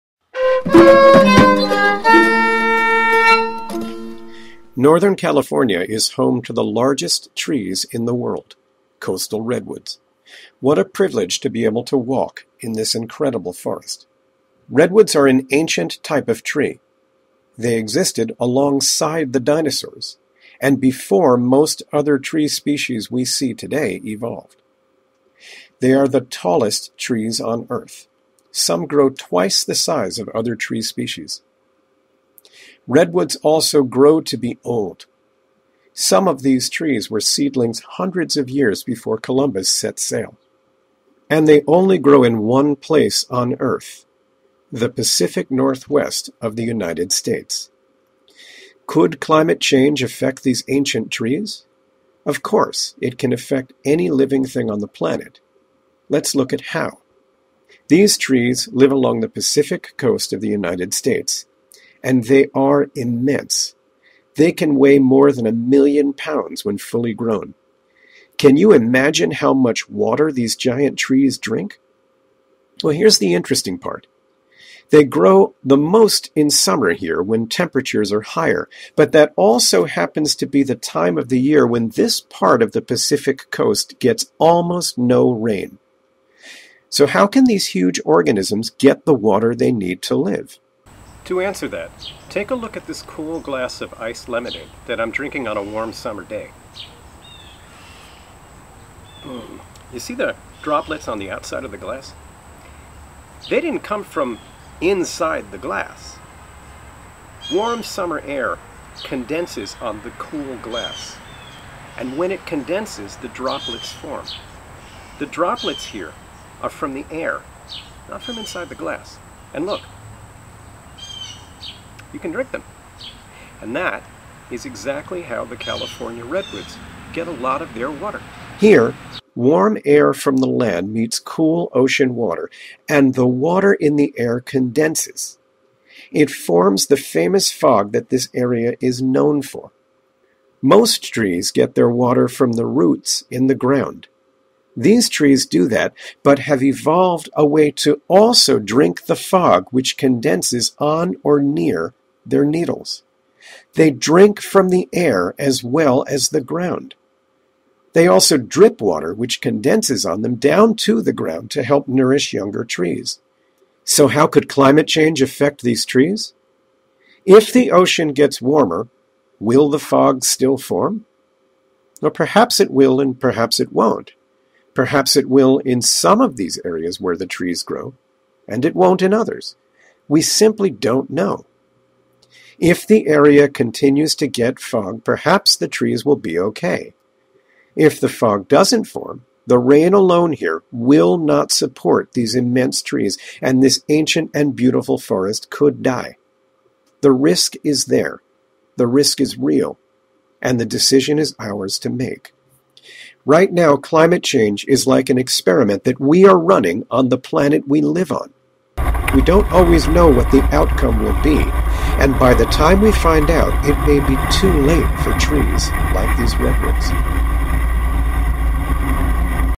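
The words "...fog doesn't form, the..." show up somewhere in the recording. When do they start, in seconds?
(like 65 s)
188 s.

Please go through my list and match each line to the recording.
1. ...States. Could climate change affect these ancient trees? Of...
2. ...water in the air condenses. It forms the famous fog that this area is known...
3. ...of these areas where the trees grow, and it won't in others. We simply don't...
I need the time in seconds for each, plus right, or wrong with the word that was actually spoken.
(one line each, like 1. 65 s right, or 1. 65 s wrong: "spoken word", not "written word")
1. 47 s right
2. 133 s right
3. 176 s right.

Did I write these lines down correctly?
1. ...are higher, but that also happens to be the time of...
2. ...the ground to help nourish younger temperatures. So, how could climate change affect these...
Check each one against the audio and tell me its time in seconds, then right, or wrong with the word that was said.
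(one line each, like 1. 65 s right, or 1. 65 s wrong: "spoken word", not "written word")
1. 78 s right
2. 161 s wrong: "trees", not "temperatures".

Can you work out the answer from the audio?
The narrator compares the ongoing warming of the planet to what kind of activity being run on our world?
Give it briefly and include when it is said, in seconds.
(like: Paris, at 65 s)
an experiment, at 205 s.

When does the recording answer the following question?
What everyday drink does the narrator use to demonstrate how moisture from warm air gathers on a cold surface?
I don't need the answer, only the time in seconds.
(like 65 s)
93 s.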